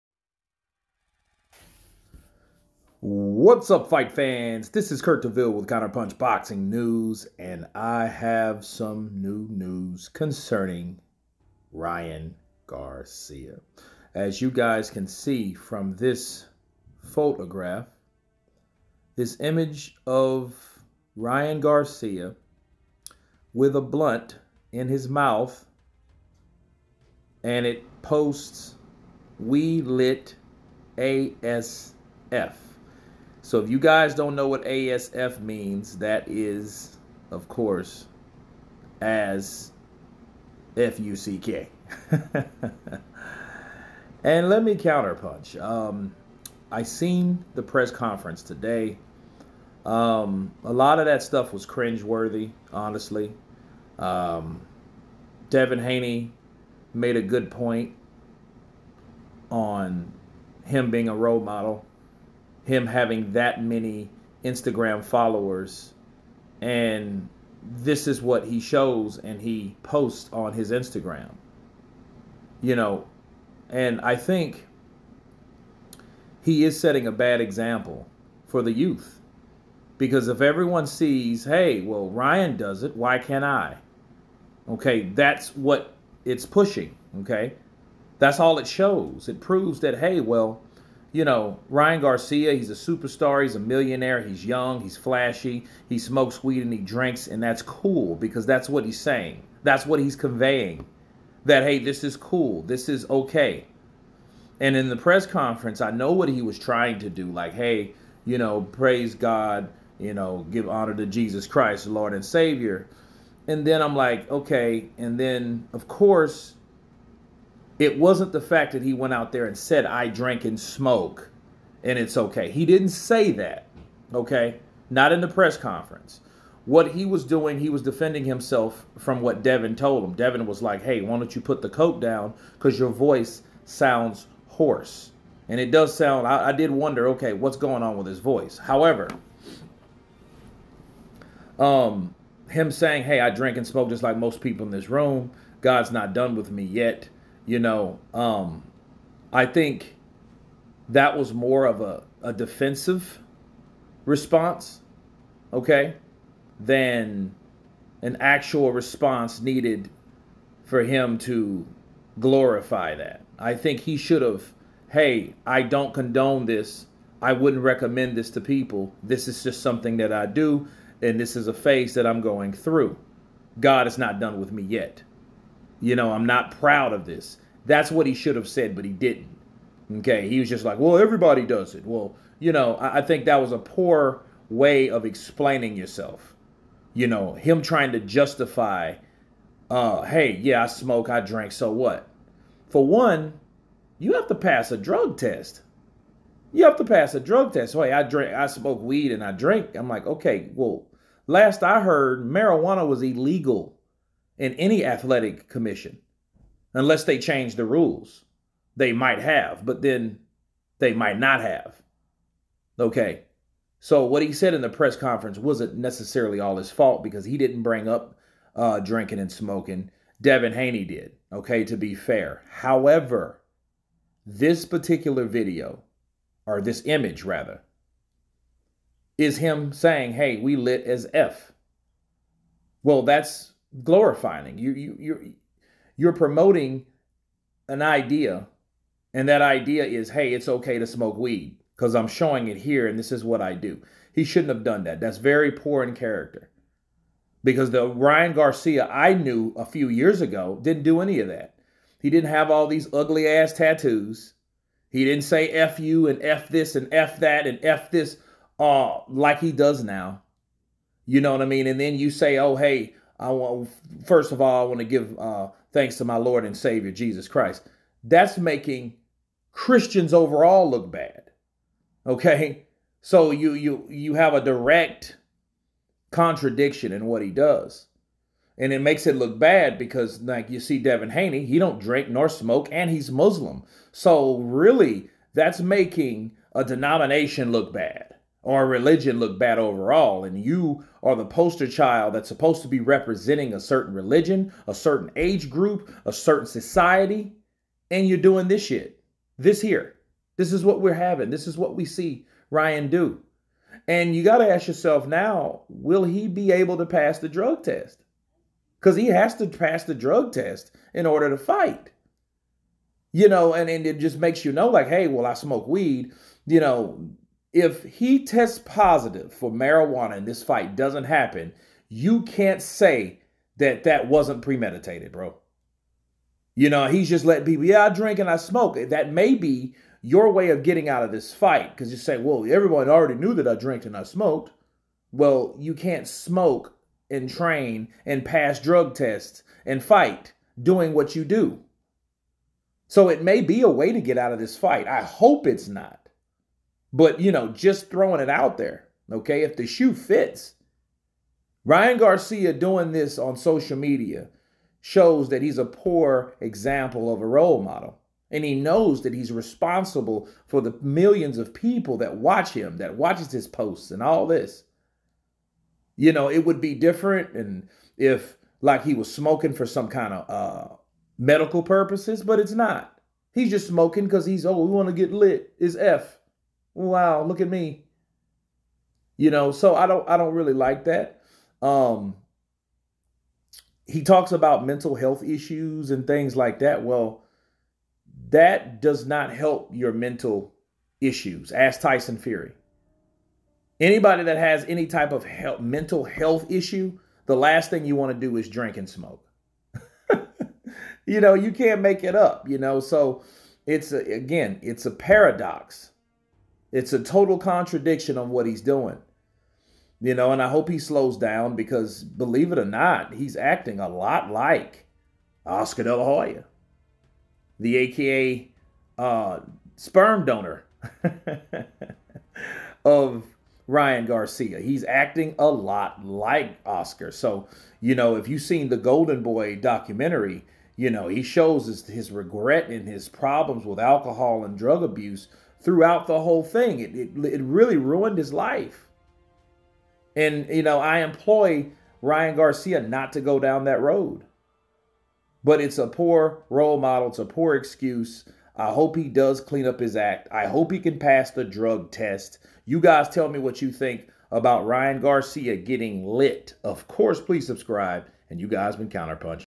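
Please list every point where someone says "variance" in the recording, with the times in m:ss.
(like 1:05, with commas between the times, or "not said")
not said.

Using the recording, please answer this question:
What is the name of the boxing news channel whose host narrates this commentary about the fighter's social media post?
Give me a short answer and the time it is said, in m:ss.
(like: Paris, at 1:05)
Counterpunch Boxing News, at 0:05.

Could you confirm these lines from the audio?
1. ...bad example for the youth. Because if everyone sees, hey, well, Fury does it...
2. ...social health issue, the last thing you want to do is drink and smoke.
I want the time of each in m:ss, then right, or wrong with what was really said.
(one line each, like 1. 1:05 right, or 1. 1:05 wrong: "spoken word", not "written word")
1. 1:17 wrong: "Ryan", not "Fury"
2. 6:35 wrong: "mental", not "social".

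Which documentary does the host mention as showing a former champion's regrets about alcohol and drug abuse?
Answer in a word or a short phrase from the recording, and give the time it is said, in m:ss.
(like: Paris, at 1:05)
Golden Boy, at 7:08.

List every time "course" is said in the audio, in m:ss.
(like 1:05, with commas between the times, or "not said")
0:37, 1:55, 7:36.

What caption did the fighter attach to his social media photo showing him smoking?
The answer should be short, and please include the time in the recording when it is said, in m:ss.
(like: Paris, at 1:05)
We Lit ASF, at 0:29.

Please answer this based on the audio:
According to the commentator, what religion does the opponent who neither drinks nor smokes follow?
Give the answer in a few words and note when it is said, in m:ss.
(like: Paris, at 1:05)
Muslim, at 4:43.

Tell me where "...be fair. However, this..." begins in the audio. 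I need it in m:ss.
3:41.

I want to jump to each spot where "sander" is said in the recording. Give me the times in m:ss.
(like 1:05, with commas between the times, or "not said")
not said.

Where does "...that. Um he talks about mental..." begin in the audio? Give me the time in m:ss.
6:20.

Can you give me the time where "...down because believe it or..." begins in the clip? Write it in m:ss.
6:51.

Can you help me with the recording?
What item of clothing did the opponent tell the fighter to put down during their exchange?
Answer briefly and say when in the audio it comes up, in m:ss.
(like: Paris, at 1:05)
coat, at 2:11.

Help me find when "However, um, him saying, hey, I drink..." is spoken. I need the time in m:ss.
2:18.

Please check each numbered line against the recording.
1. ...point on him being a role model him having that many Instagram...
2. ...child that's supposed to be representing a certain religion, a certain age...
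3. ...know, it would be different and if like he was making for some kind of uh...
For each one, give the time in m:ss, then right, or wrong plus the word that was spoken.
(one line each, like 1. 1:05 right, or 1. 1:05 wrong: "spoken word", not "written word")
1. 0:57 right
2. 4:51 right
3. 6:06 wrong: "smoking", not "making".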